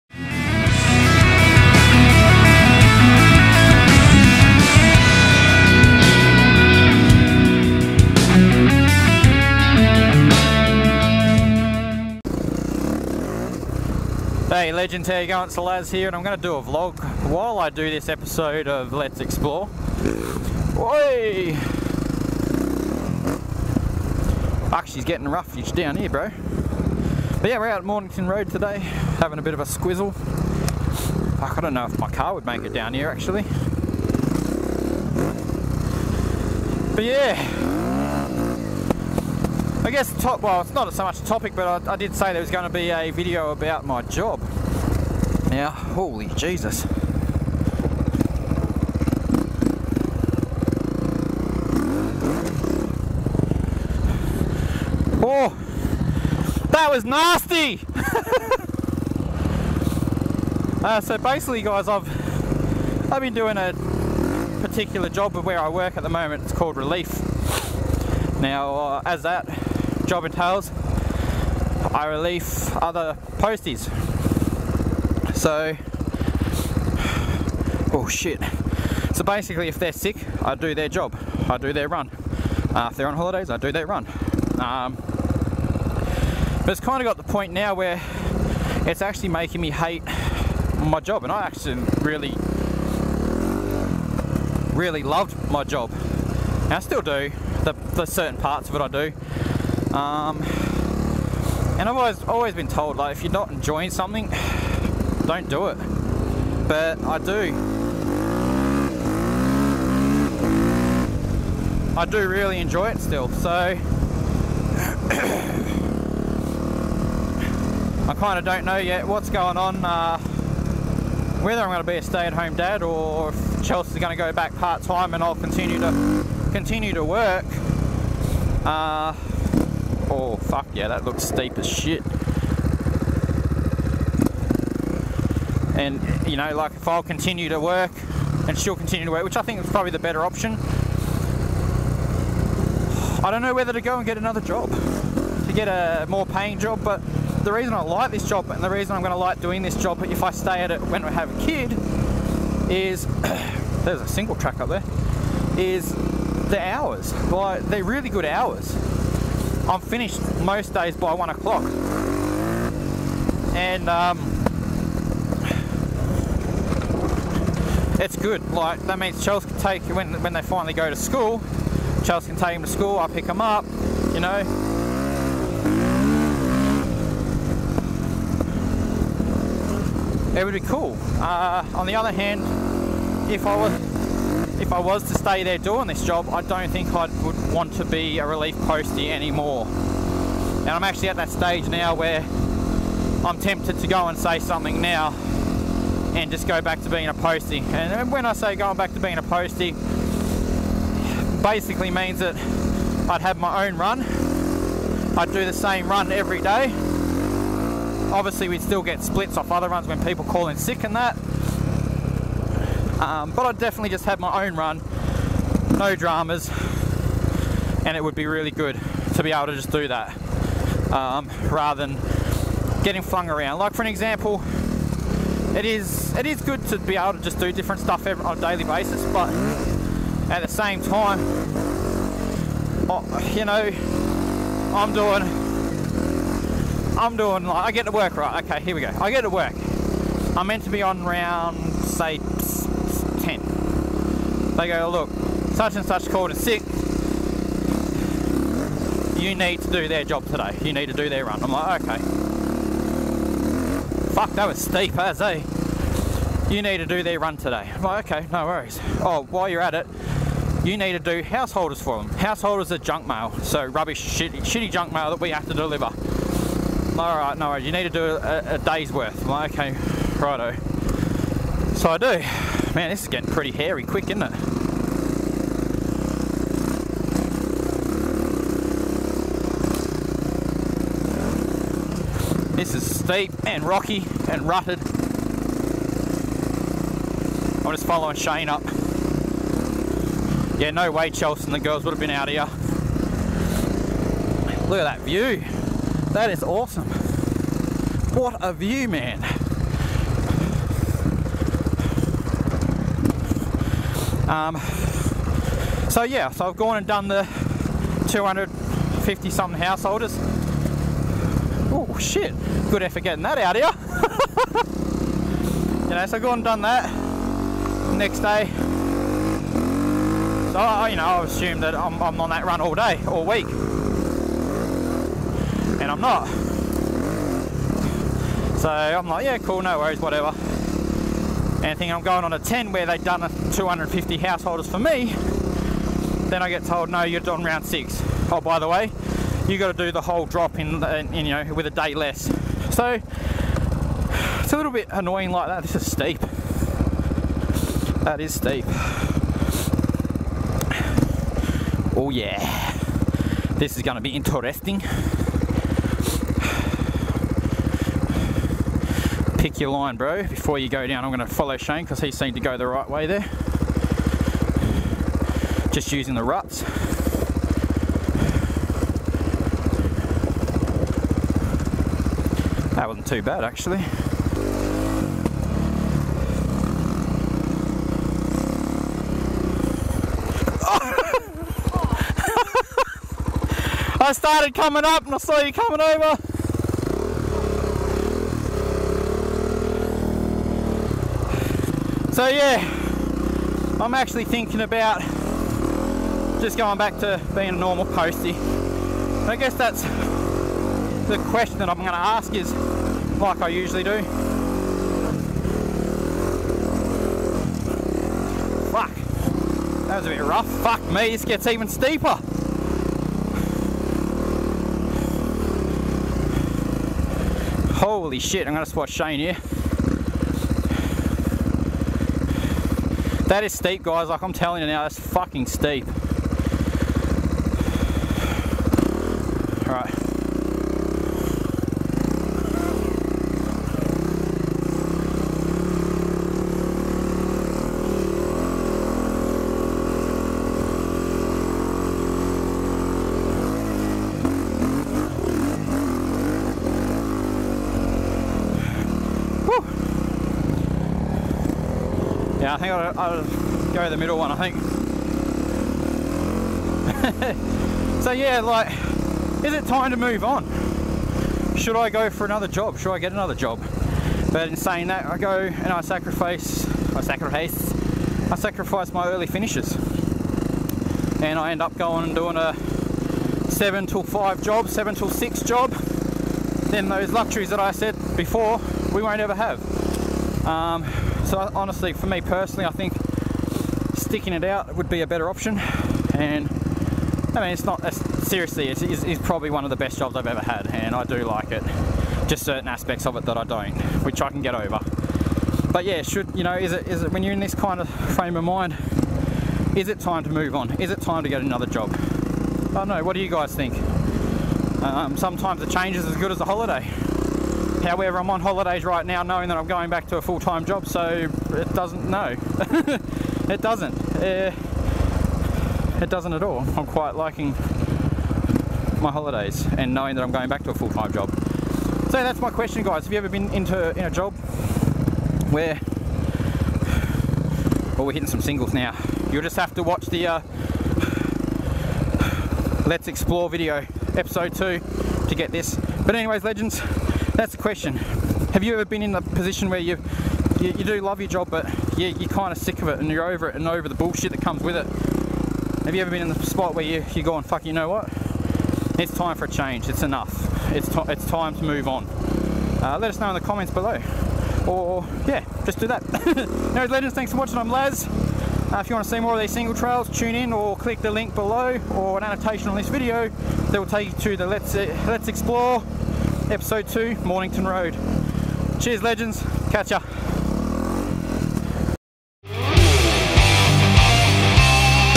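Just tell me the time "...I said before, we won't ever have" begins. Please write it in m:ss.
7:57.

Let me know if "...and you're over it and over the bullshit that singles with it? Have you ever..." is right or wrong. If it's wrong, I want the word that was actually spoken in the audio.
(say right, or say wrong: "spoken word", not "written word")
wrong: "comes", not "singles".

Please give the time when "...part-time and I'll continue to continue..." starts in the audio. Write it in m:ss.
2:04.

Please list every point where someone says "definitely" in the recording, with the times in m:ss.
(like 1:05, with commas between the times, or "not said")
3:33.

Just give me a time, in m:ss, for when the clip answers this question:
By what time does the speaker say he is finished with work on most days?
2:41.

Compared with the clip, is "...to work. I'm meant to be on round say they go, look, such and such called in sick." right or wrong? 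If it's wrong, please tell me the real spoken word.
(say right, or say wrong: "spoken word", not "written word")
right.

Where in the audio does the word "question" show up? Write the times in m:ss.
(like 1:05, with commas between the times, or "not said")
6:41, 8:42, 8:57.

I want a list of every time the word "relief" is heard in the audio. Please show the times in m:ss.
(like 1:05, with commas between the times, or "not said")
1:06, 1:12, 3:08.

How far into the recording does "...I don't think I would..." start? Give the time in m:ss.
3:06.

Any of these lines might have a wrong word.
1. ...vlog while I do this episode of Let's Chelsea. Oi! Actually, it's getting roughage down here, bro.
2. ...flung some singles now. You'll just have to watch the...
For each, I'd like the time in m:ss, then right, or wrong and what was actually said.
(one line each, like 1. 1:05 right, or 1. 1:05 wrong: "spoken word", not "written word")
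1. 0:16 wrong: "Explore", not "Chelsea"
2. 8:48 wrong: "hitting", not "flung".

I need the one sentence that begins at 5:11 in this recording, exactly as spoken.
Oh shit, good effort getting that out here.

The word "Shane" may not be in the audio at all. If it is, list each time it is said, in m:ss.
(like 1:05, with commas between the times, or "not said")
4:48, 6:01, 6:58.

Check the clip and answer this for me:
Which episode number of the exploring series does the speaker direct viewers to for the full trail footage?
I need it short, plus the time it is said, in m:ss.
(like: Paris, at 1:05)
2, at 8:54.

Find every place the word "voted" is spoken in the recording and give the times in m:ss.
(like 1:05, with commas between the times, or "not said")
not said.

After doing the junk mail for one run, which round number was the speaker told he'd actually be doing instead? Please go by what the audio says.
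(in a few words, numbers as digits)
Round 6.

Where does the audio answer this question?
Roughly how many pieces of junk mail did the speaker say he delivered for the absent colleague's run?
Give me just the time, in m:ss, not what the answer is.
5:08.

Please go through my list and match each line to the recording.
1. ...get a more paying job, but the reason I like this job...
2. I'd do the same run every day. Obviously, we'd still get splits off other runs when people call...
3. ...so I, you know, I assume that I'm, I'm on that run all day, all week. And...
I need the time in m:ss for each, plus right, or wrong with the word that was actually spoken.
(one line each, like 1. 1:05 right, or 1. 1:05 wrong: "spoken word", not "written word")
1. 2:25 right
2. 3:25 right
3. 5:20 right.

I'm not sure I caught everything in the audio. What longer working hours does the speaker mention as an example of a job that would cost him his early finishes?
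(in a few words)
7 till 5.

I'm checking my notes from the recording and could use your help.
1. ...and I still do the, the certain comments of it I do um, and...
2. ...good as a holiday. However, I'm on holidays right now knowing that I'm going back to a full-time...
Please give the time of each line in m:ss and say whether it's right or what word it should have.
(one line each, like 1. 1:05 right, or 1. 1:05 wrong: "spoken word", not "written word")
1. 1:36 wrong: "parts", not "comments"
2. 8:26 right.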